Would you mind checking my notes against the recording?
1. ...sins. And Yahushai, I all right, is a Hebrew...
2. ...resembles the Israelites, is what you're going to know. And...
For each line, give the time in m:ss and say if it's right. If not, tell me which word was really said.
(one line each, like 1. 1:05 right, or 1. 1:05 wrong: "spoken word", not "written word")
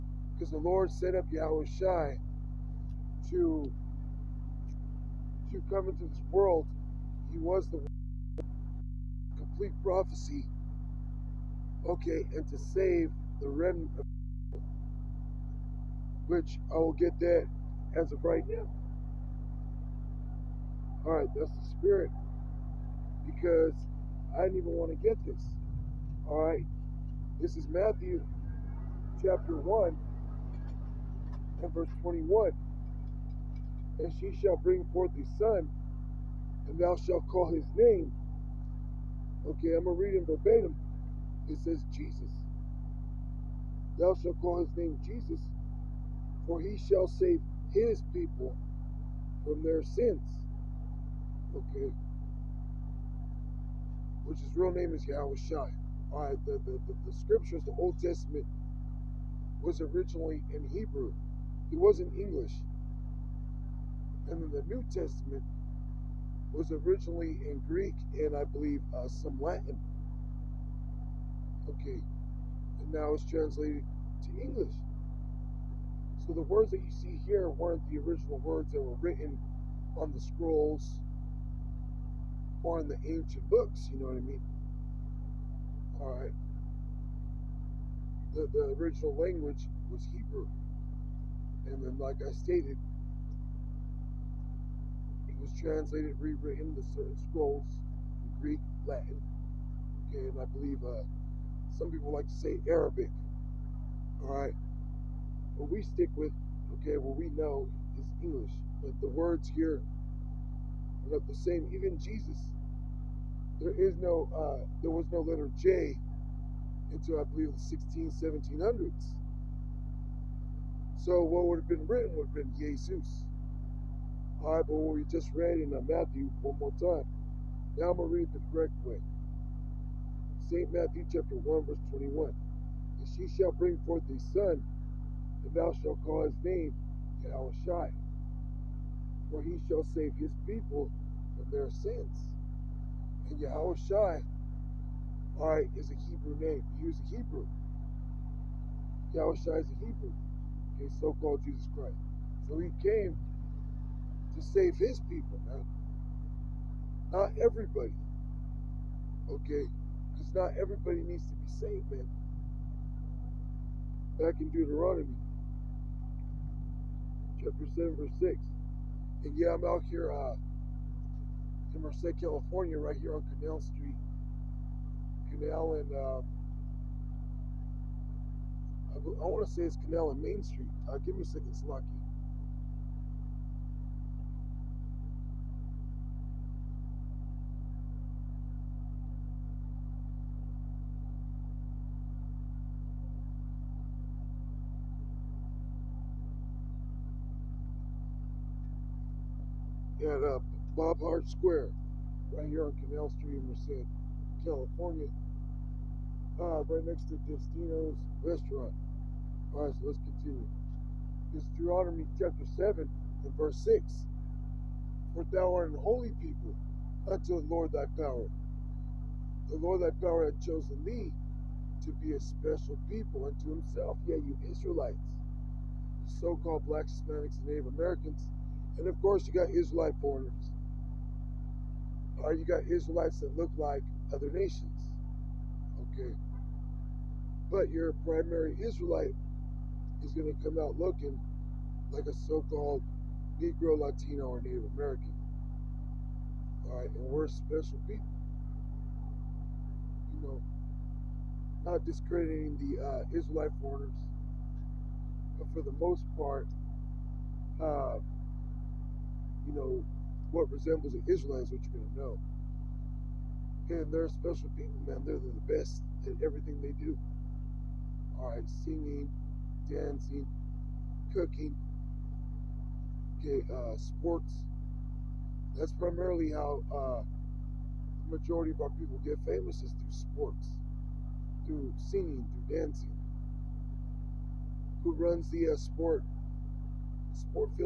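1. 2:21 right
2. 4:20 right.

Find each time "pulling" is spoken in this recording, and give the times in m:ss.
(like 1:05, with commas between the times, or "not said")
not said.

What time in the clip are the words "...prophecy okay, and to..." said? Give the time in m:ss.
0:09.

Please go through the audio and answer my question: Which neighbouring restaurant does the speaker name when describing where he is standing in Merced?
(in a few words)
Destino's.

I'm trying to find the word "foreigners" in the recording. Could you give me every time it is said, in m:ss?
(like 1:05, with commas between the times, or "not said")
3:50, 4:13.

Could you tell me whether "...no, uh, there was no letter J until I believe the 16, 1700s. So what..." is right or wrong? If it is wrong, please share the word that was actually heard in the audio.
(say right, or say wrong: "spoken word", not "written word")
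right.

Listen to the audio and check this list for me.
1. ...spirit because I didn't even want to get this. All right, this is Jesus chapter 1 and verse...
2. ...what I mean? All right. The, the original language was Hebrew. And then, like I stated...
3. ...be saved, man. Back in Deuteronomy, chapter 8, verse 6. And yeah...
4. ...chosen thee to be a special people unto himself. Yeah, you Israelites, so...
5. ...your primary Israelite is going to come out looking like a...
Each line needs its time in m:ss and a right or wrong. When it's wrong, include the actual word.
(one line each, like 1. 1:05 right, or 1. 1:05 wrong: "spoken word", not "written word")
1. 0:21 wrong: "Matthew", not "Jesus"
2. 1:24 right
3. 2:41 wrong: "7", not "8"
4. 3:40 right
5. 3:57 right.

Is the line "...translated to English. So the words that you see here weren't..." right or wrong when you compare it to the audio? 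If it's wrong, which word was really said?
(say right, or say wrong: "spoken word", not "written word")
right.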